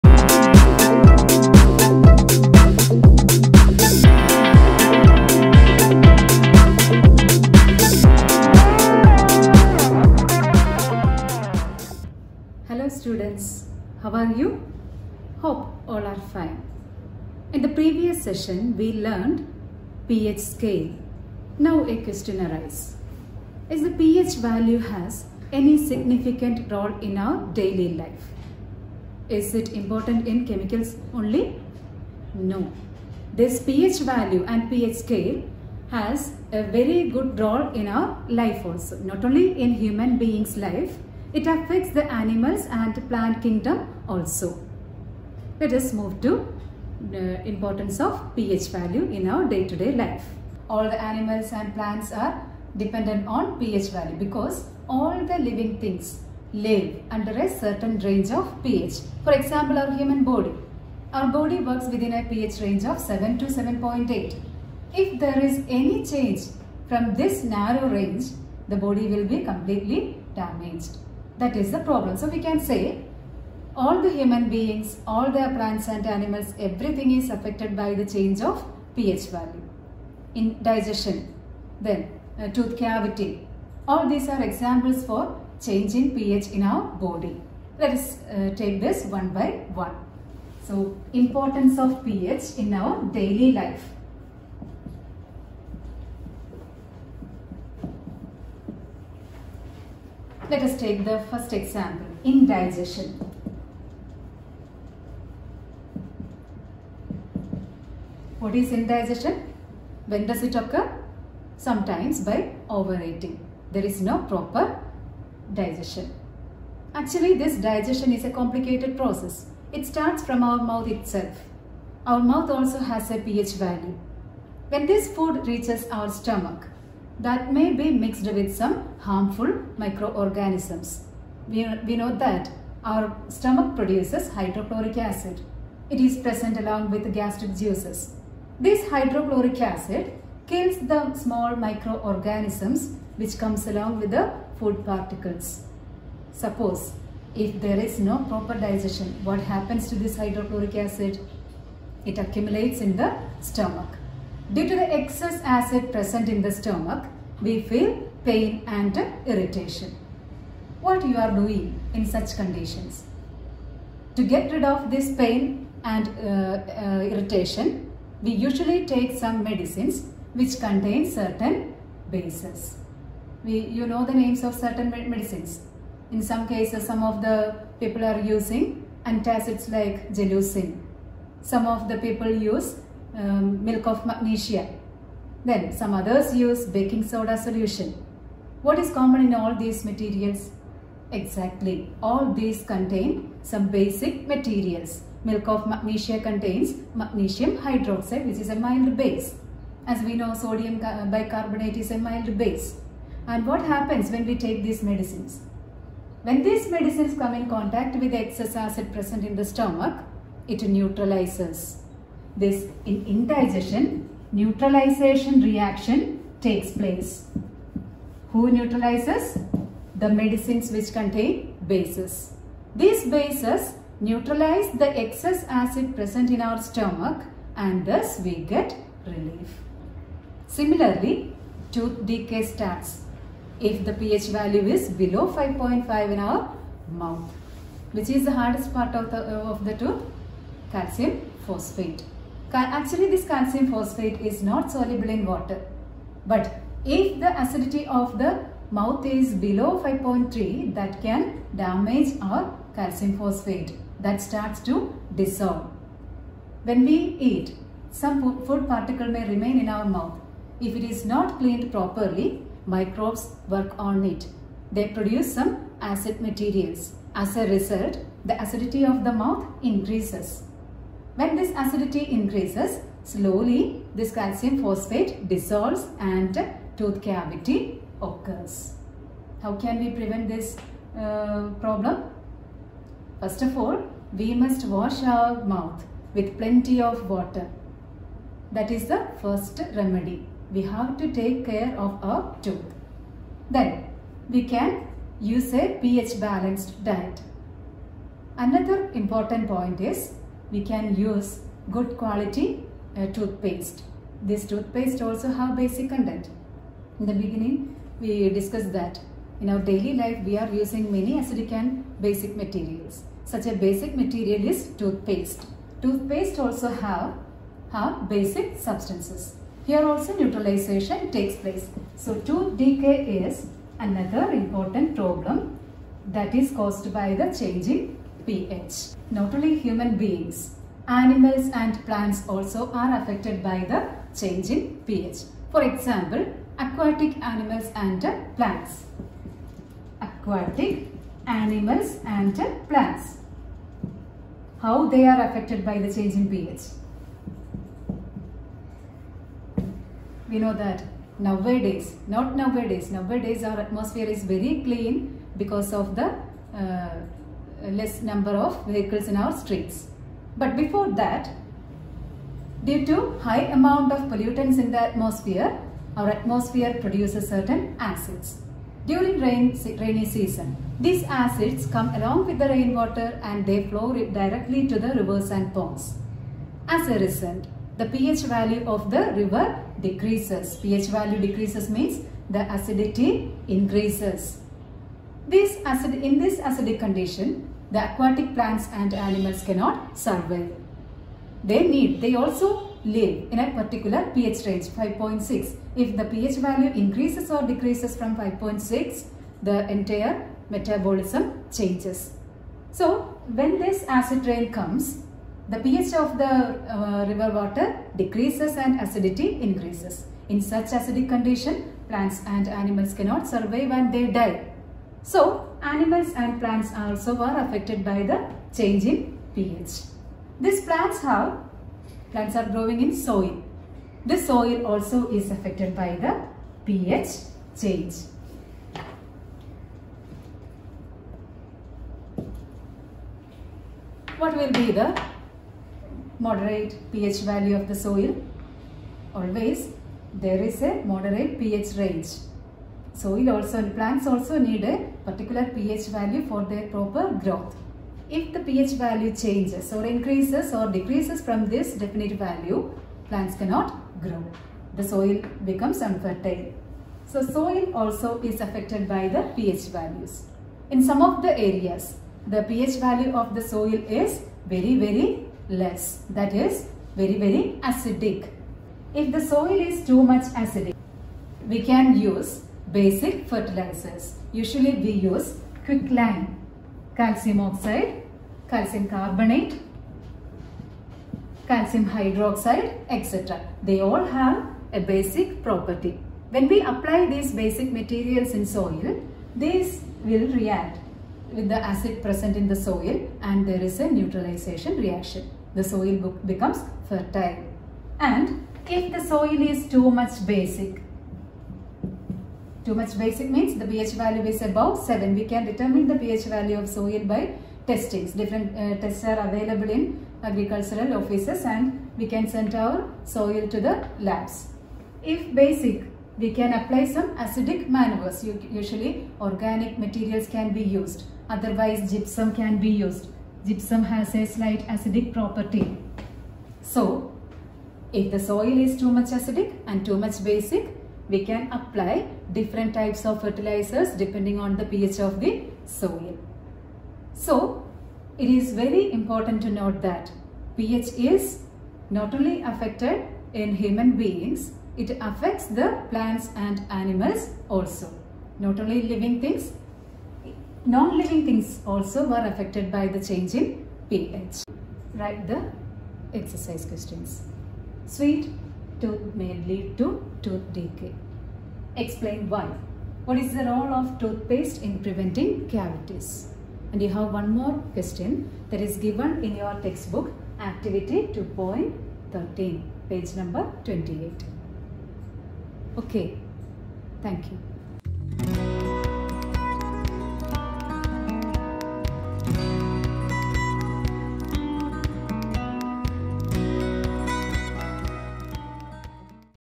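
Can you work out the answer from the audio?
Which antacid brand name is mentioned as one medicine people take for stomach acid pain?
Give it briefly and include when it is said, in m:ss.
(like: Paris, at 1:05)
Gelusil, at 3:00.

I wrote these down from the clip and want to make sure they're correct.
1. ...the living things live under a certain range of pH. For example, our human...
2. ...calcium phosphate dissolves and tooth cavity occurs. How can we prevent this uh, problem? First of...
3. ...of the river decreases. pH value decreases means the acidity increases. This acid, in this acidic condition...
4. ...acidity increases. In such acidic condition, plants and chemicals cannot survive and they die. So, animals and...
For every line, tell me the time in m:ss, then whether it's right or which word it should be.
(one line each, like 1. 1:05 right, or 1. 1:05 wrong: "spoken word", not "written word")
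1. 0:55 right
2. 4:34 right
3. 6:18 right
4. 6:48 wrong: "animals", not "chemicals".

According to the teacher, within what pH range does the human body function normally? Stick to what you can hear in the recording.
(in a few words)
7 to 7.8.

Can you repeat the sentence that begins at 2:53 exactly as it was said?
We, you know the names of certain medicines.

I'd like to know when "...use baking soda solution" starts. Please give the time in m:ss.
3:06.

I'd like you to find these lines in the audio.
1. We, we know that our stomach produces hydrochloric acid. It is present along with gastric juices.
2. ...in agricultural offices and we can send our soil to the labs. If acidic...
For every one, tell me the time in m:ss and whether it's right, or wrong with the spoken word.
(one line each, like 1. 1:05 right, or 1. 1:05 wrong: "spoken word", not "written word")
1. 2:11 right
2. 8:29 wrong: "basic", not "acidic".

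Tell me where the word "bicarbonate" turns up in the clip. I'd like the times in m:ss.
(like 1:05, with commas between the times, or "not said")
3:21.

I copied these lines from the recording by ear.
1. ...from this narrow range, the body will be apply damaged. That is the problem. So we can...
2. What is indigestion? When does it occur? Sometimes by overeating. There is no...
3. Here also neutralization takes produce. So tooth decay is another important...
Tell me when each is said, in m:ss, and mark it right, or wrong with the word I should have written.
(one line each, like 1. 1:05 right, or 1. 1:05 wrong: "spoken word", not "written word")
1. 1:06 wrong: "completely", not "apply"
2. 1:48 right
3. 5:19 wrong: "place", not "produce".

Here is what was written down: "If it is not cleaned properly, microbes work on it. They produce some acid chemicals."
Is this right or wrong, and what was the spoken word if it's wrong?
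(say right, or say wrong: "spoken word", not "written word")
wrong: "materials", not "chemicals".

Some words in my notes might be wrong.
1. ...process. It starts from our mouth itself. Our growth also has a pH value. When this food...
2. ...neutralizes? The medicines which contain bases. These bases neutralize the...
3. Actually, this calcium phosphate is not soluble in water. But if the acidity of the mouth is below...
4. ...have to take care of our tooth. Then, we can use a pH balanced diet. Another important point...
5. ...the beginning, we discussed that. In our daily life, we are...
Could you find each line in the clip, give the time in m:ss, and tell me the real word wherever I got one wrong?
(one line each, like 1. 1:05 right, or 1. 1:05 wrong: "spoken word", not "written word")
1. 1:58 wrong: "mouth", not "growth"
2. 3:38 right
3. 4:02 right
4. 4:50 right
5. 5:07 right.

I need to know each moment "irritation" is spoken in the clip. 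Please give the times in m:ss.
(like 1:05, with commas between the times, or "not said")
2:39, 2:47.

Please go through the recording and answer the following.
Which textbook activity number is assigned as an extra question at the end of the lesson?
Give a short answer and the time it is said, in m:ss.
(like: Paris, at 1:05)
Activity 2.13, at 9:30.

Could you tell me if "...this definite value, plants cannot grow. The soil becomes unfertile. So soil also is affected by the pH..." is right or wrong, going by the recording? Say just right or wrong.
right.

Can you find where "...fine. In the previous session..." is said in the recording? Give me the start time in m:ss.
0:16.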